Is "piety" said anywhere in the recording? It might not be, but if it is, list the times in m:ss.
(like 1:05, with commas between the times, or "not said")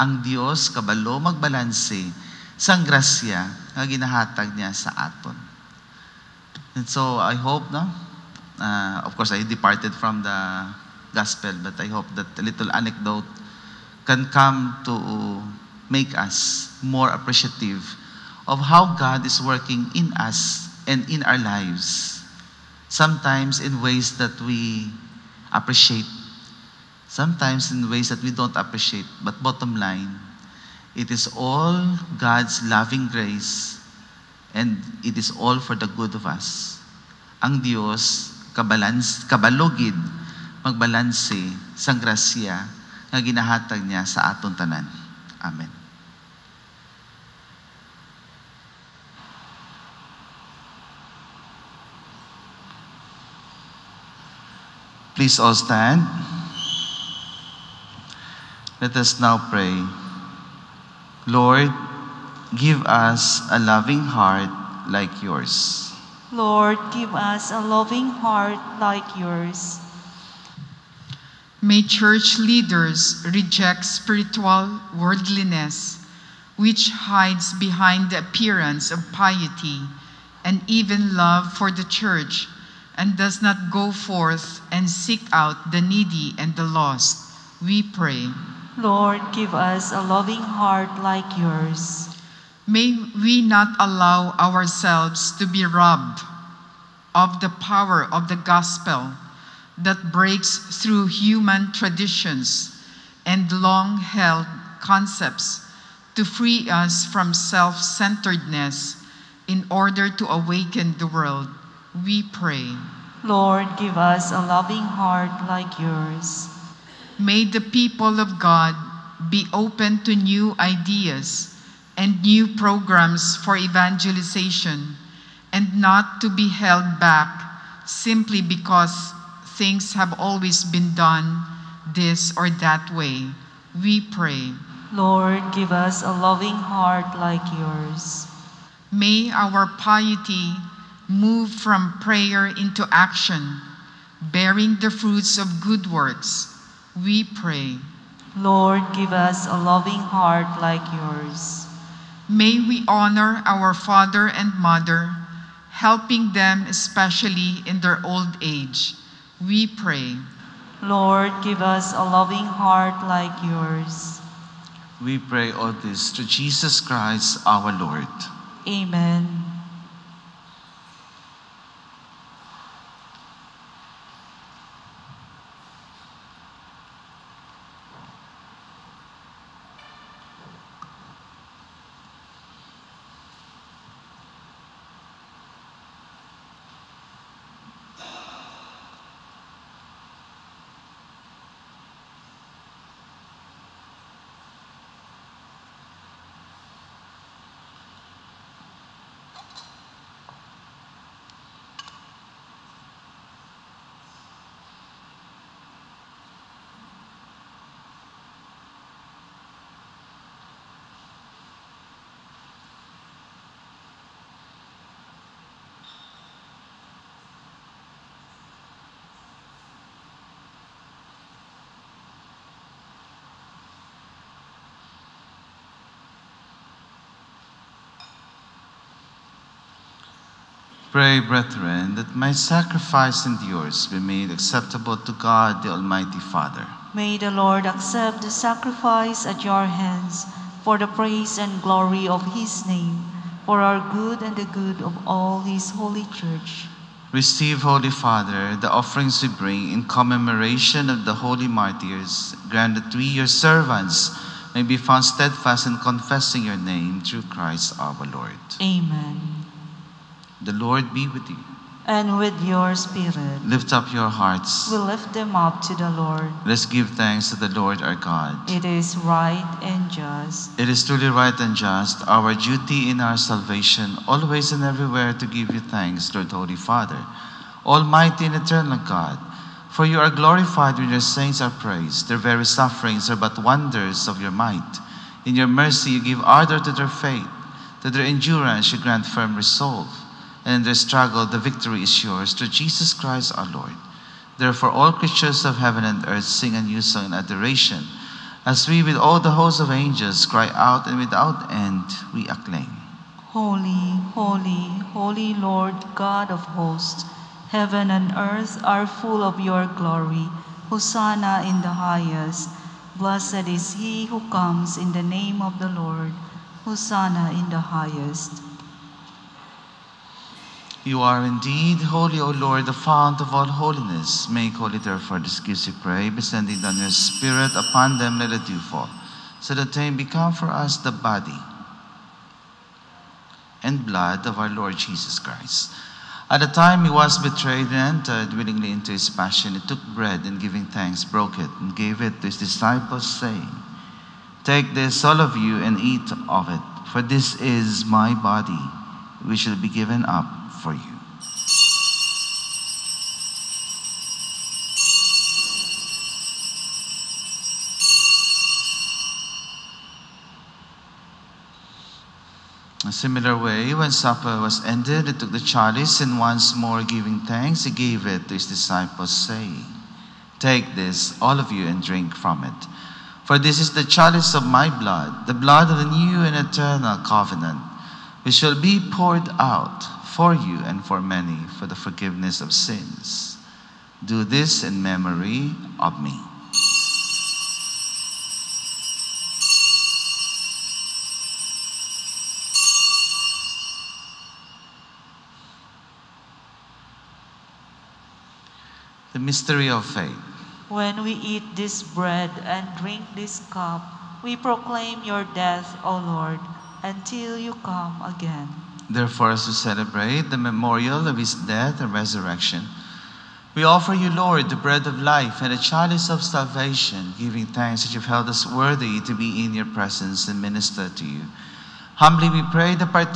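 1:19, 2:19.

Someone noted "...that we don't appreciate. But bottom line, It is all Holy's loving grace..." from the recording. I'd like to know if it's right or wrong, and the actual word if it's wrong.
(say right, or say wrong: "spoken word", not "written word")
wrong: "God", not "Holy".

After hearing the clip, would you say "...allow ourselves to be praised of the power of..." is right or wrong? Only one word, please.
wrong.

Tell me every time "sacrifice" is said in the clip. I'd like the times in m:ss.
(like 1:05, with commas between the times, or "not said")
3:52, 3:58.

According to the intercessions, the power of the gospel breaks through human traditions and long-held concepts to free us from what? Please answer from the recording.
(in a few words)
self-centeredness.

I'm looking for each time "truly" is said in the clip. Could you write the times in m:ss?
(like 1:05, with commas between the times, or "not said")
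4:30.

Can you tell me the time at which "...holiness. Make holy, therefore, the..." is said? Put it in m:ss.
5:23.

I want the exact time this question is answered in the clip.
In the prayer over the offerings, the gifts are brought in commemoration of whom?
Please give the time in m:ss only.
4:11.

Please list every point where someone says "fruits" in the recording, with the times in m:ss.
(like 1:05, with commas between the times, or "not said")
2:24.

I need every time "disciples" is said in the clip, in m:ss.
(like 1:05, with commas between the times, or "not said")
5:42, 6:08.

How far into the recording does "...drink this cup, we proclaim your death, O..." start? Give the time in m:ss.
6:42.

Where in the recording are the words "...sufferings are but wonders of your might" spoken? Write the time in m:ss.
4:42.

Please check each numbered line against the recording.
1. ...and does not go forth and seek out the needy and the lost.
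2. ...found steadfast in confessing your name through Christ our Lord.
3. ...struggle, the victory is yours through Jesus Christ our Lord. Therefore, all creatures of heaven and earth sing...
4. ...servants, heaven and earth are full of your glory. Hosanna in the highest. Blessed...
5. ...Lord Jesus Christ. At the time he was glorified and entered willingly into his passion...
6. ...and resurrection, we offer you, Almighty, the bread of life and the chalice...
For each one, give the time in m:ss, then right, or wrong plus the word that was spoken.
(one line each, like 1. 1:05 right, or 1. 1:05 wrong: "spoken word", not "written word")
1. 1:22 right
2. 4:14 right
3. 4:50 right
4. 5:06 wrong: "hosts", not "servants"
5. 5:34 wrong: "betrayed", not "glorified"
6. 6:51 wrong: "Lord", not "Almighty".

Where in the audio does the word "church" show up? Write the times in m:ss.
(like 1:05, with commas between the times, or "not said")
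1:11, 1:21, 4:06.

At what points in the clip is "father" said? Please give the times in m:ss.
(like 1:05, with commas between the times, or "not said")
2:33, 3:56, 4:07, 4:36.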